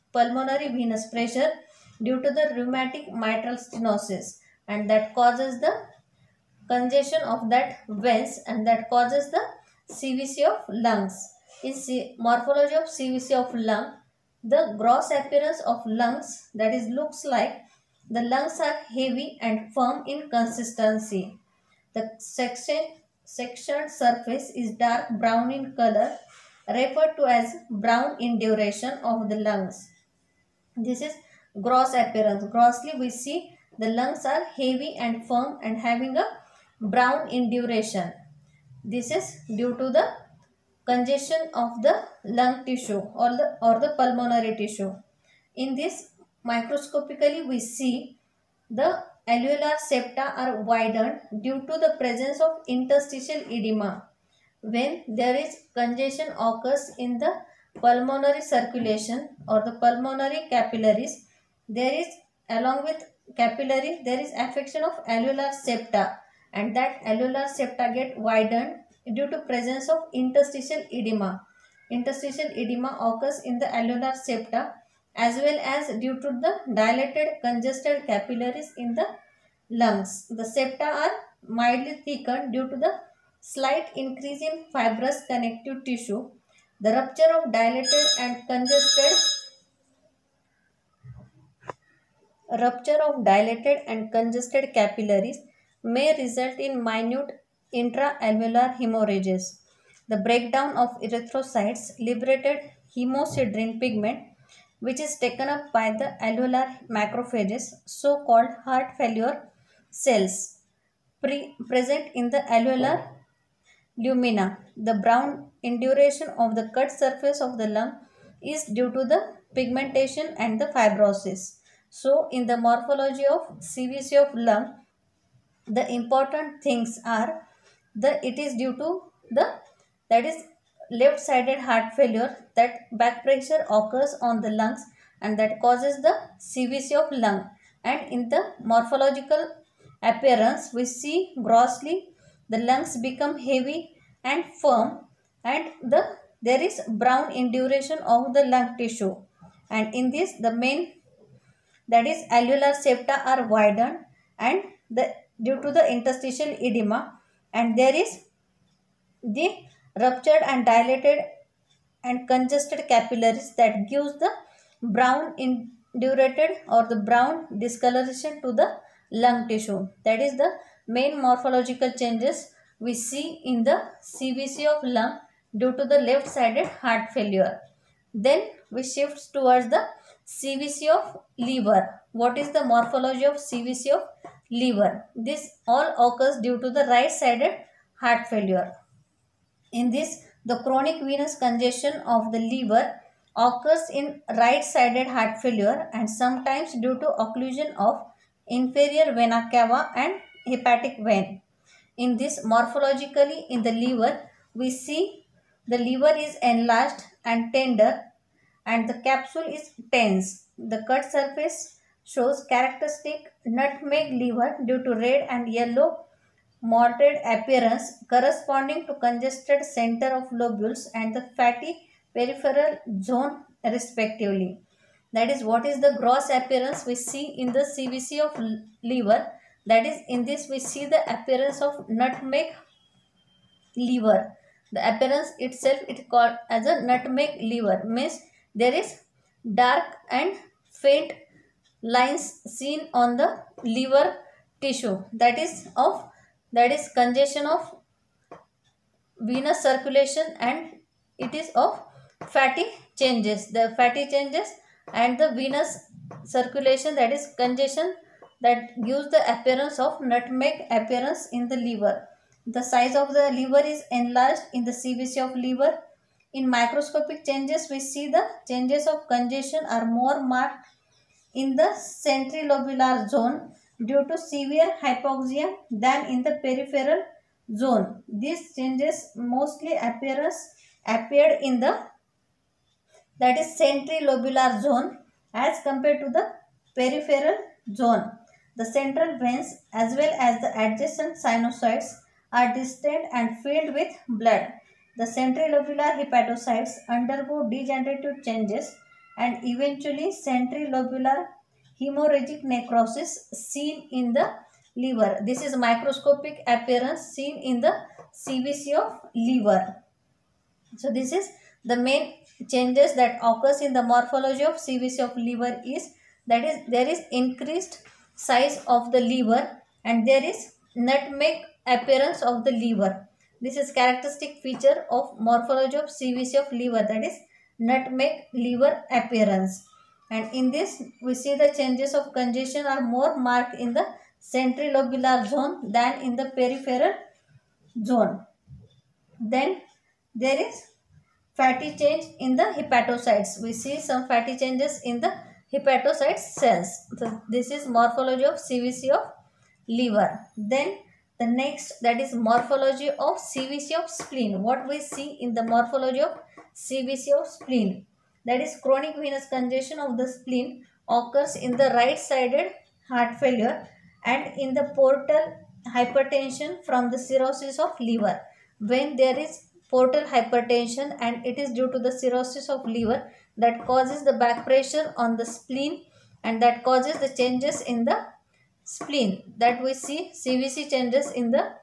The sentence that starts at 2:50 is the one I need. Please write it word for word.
That is the main morphological changes we see in the CVC of lung due to the left-sided heart failure.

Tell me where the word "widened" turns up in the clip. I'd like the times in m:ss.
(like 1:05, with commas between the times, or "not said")
0:50, 1:08, 2:33.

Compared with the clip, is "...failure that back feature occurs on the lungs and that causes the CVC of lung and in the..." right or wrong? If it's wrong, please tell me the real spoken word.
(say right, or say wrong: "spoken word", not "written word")
wrong: "pressure", not "feature".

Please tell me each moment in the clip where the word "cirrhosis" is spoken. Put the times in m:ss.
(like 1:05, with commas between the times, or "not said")
6:06, 6:11.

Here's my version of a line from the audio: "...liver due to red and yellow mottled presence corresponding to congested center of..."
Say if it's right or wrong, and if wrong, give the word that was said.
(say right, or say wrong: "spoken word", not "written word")
wrong: "appearance", not "presence".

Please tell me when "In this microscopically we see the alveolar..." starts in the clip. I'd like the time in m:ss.
0:45.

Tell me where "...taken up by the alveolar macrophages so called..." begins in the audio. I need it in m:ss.
1:45.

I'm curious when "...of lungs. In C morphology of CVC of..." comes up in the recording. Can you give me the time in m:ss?
0:10.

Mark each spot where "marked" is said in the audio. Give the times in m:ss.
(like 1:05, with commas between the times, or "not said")
4:30, 5:33.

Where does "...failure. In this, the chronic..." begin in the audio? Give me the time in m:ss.
3:08.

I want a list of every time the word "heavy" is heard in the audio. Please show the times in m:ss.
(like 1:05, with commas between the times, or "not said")
0:18, 0:34, 2:23.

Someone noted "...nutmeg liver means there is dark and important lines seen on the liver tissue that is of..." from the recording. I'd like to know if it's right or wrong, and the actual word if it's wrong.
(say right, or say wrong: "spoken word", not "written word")
wrong: "faint", not "important".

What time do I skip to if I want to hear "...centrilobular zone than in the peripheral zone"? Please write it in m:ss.
5:34.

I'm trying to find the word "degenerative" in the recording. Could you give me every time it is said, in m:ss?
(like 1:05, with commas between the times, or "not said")
4:57.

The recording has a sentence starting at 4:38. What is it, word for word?
These changes mostly appears, appeared in the that is centrilobular zone as compared to the peripheral zone.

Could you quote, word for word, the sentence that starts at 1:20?
The septa are mildly thickened due to the slight increase in fibrous connective tissue.